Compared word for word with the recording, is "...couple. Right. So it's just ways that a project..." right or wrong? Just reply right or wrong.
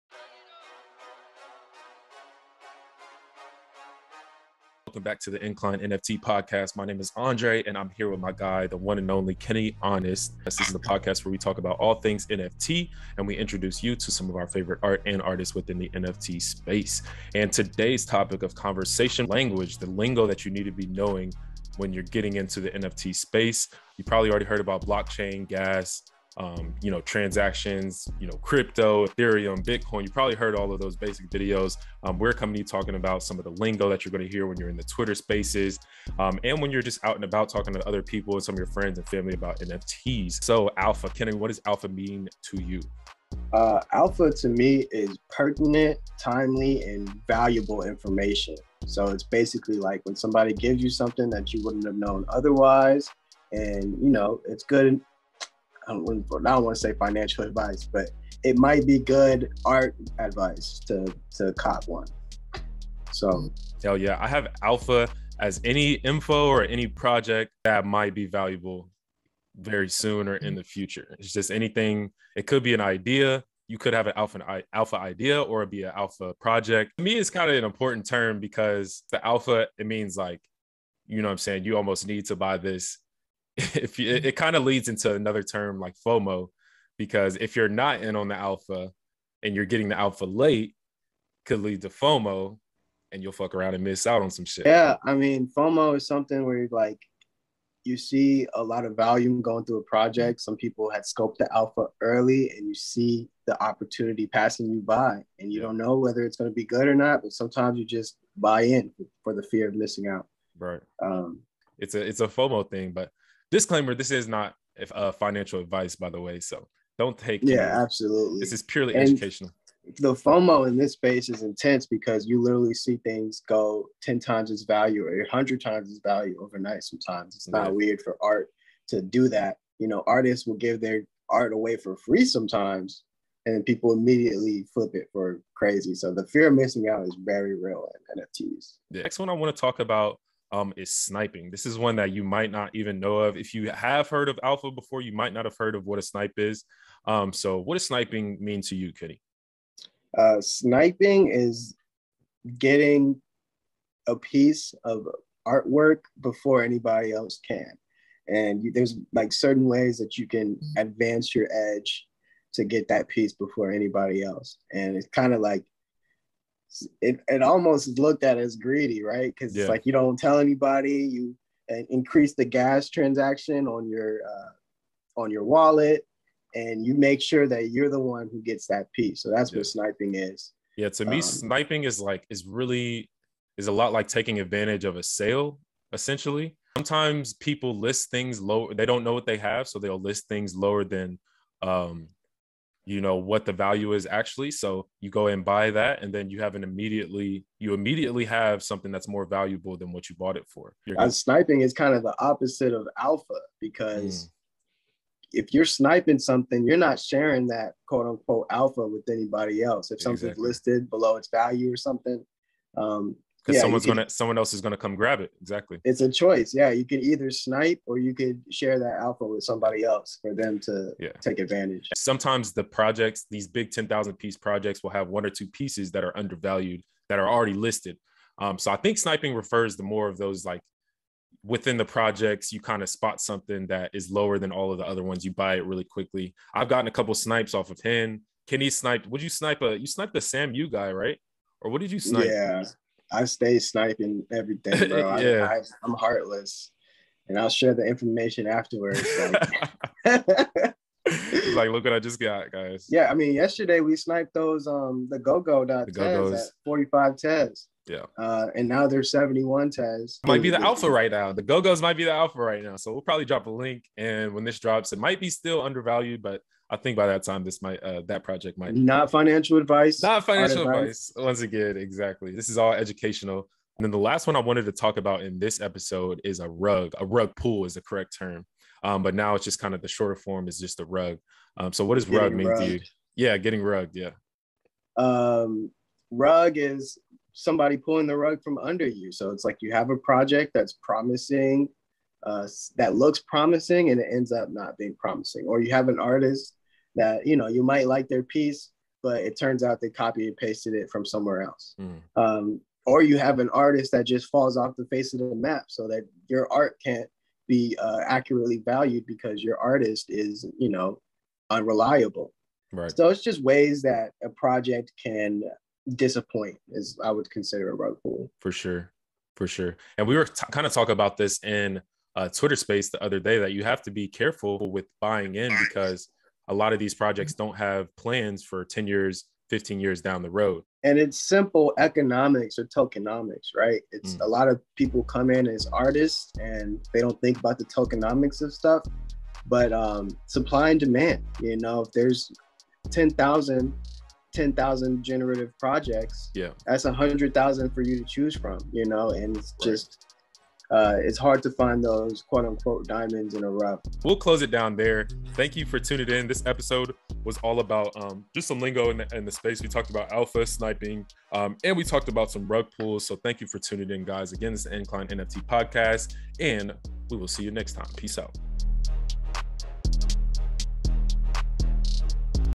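wrong.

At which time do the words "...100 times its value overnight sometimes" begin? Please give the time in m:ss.
2:05.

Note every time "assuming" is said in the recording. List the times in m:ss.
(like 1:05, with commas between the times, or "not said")
not said.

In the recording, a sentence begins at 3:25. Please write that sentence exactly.
if you're sniping something you're not sharing that quote unquote alpha with anybody else if something's exactly.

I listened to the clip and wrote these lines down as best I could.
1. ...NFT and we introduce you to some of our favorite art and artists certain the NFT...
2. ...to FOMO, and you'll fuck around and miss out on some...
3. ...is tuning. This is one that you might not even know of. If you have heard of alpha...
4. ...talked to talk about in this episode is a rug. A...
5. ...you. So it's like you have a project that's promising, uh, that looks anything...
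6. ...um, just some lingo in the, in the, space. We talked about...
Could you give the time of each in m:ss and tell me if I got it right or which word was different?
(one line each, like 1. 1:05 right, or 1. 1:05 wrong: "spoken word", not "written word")
1. 0:12 wrong: "within", not "certain"
2. 1:31 right
3. 2:20 wrong: "sniping", not "tuning"
4. 4:34 wrong: "wanted", not "talked"
5. 4:48 wrong: "promising", not "anything"
6. 5:58 right.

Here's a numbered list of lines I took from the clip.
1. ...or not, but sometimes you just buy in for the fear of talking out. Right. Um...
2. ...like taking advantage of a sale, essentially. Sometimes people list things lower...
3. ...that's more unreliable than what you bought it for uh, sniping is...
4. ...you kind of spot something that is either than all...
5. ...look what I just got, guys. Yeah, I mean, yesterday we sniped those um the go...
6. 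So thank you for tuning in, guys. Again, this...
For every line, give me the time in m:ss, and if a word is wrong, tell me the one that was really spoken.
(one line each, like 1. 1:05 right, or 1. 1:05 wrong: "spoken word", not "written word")
1. 1:46 wrong: "missing", not "talking"
2. 3:03 right
3. 3:18 wrong: "valuable", not "unreliable"
4. 3:52 wrong: "lower", not "either"
5. 4:11 right
6. 6:03 right.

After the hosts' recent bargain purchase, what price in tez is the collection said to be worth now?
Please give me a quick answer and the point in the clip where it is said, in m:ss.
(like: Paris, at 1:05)
71 tez, at 4:19.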